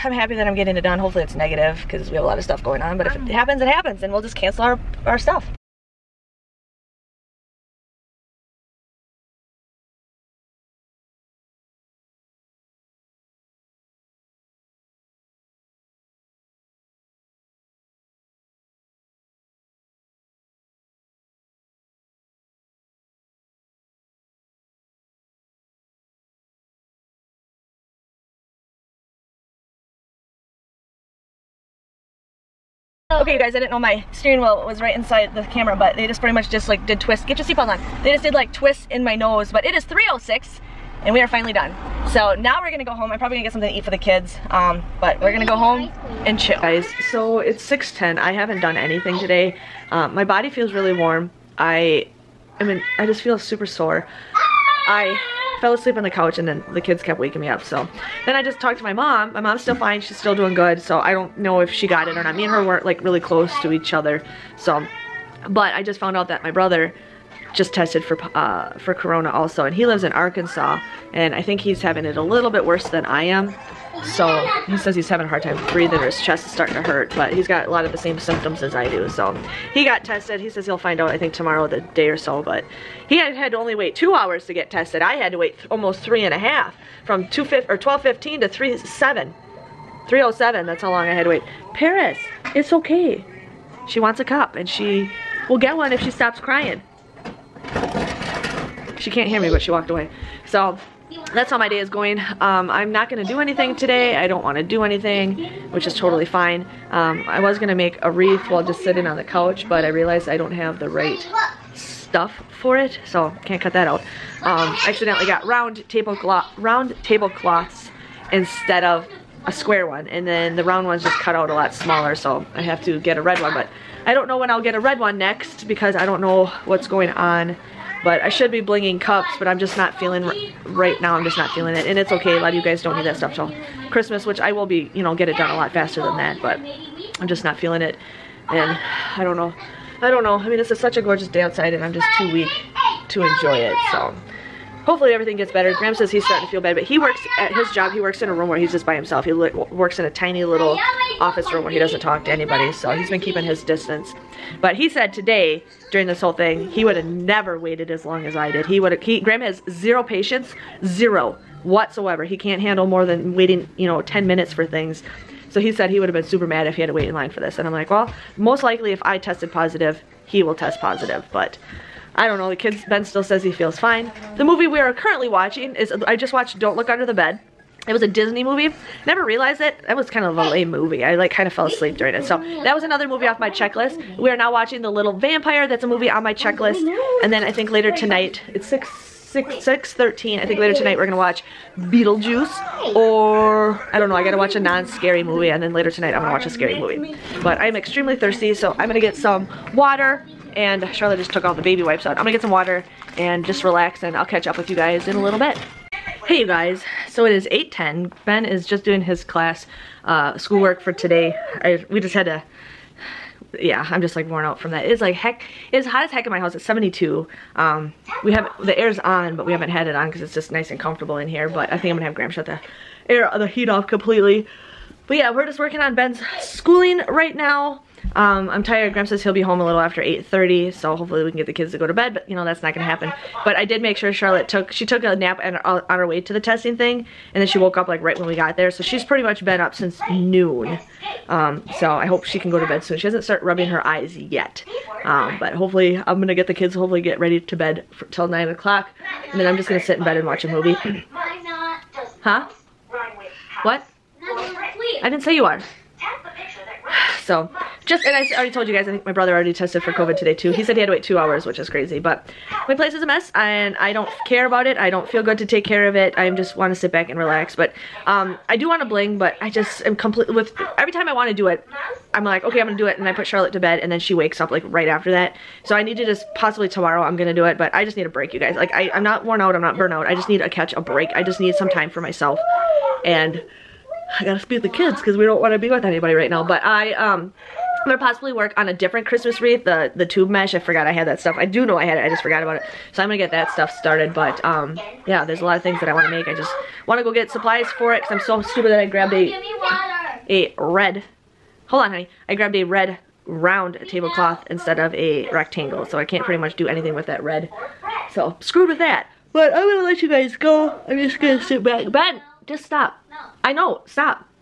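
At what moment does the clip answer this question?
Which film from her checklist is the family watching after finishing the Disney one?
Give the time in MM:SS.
03:04.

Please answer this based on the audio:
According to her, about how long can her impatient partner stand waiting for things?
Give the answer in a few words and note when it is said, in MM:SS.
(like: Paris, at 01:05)
10 minutes, at 02:44.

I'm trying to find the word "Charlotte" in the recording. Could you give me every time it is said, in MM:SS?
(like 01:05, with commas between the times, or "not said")
03:20, 03:54, 04:33.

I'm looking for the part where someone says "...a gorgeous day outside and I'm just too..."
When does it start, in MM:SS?
02:20.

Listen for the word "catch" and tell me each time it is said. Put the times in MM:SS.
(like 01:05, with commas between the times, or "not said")
03:24, 04:40.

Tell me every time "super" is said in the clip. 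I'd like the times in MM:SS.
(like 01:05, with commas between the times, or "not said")
00:53, 02:46.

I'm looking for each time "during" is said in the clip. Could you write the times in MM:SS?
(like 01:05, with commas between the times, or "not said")
02:35, 03:01.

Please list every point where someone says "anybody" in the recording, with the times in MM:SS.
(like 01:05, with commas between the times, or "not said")
02:32, 04:45.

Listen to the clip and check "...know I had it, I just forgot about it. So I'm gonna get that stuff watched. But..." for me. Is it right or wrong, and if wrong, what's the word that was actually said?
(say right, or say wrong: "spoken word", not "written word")
wrong: "started", not "watched".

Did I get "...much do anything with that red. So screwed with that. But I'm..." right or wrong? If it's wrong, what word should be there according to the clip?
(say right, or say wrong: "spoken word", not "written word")
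right.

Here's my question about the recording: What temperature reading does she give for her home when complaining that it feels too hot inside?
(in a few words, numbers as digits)
72.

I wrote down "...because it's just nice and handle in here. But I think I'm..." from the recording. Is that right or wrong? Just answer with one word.
wrong.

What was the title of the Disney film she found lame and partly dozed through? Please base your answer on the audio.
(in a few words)
Don't Look Under the Bed.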